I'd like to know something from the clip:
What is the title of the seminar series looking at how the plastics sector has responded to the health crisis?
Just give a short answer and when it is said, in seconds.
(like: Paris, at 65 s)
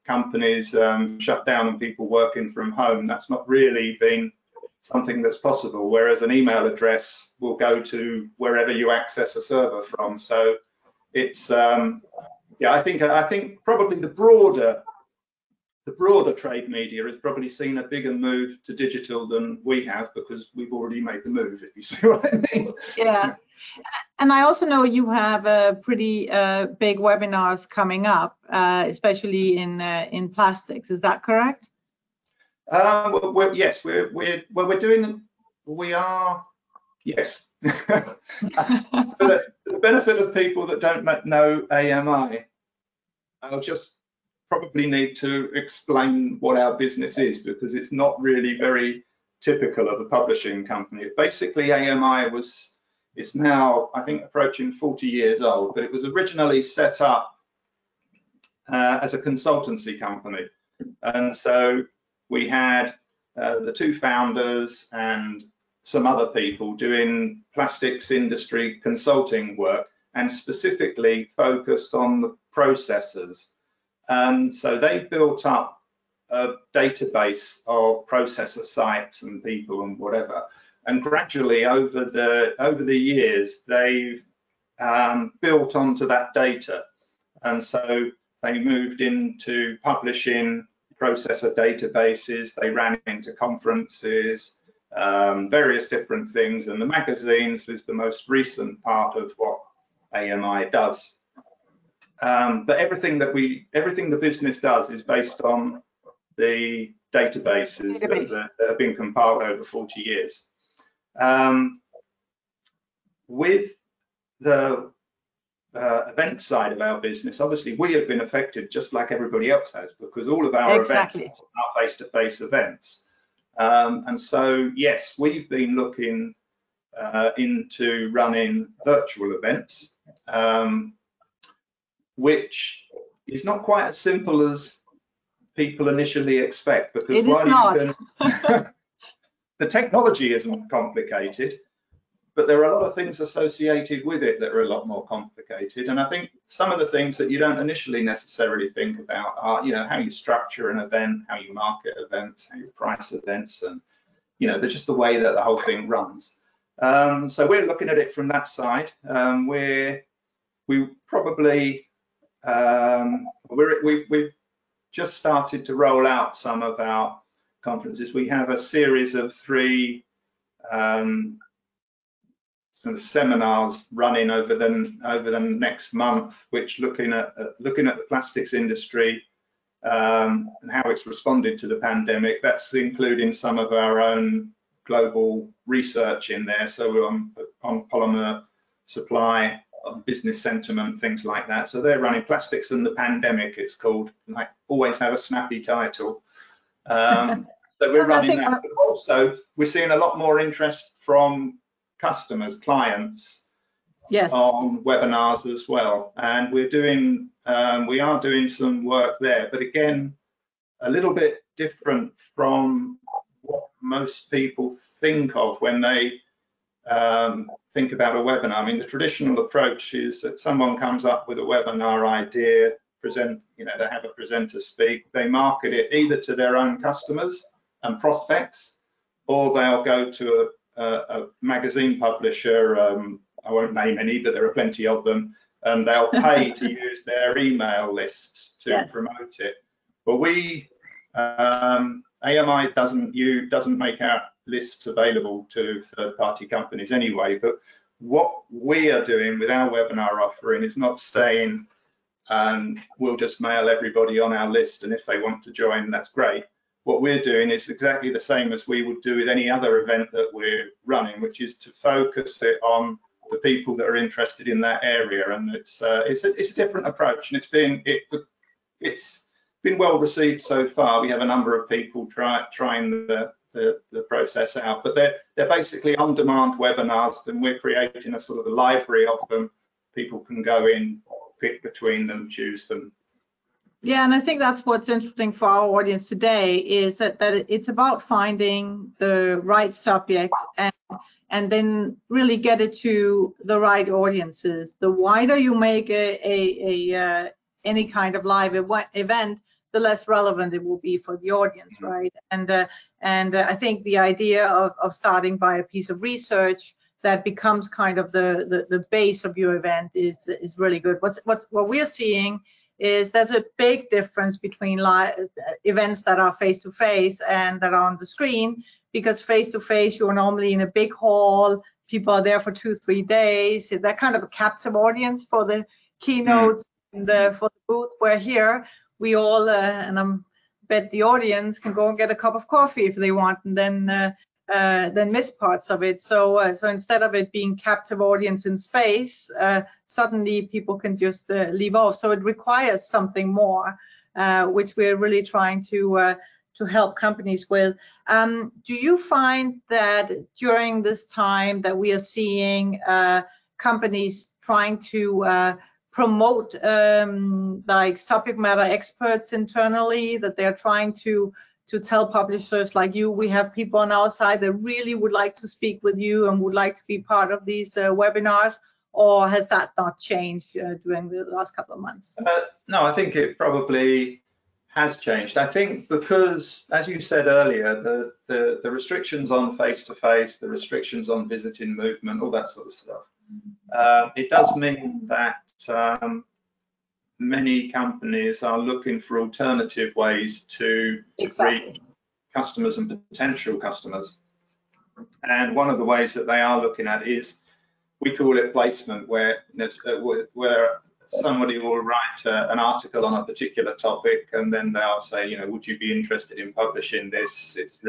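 Plastics and the Pandemic, at 192 s.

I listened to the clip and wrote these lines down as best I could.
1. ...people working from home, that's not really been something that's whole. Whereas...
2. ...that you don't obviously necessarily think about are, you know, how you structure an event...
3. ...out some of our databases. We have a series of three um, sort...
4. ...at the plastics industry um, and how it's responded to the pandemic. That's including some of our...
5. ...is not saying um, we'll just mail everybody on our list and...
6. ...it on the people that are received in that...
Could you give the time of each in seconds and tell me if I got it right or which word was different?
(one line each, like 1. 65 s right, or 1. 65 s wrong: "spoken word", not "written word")
1. 1 s wrong: "possible", not "whole"
2. 147 s wrong: "initially", not "obviously"
3. 166 s wrong: "conferences", not "databases"
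4. 177 s right
5. 250 s right
6. 262 s wrong: "interested", not "received".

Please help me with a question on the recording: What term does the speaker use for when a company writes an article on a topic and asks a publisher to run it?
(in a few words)
Placement.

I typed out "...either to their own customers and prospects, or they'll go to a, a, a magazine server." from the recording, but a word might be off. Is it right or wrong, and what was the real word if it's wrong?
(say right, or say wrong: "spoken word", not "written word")
wrong: "publisher", not "server".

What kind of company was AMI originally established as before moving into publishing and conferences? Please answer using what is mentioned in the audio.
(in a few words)
A consultancy company.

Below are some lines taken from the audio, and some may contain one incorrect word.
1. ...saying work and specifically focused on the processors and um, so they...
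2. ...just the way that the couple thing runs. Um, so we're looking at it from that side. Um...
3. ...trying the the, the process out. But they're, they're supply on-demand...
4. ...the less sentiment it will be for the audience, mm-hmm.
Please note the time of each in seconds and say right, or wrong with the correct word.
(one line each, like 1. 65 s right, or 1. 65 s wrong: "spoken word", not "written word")
1. 68 s wrong: "consulting", not "saying"
2. 154 s wrong: "whole", not "couple"
3. 272 s wrong: "basically", not "supply"
4. 299 s wrong: "relevant", not "sentiment".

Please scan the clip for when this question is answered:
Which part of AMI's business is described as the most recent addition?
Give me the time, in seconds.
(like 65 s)
96 s.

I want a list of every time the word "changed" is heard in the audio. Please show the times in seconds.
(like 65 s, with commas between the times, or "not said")
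369 s, 374 s.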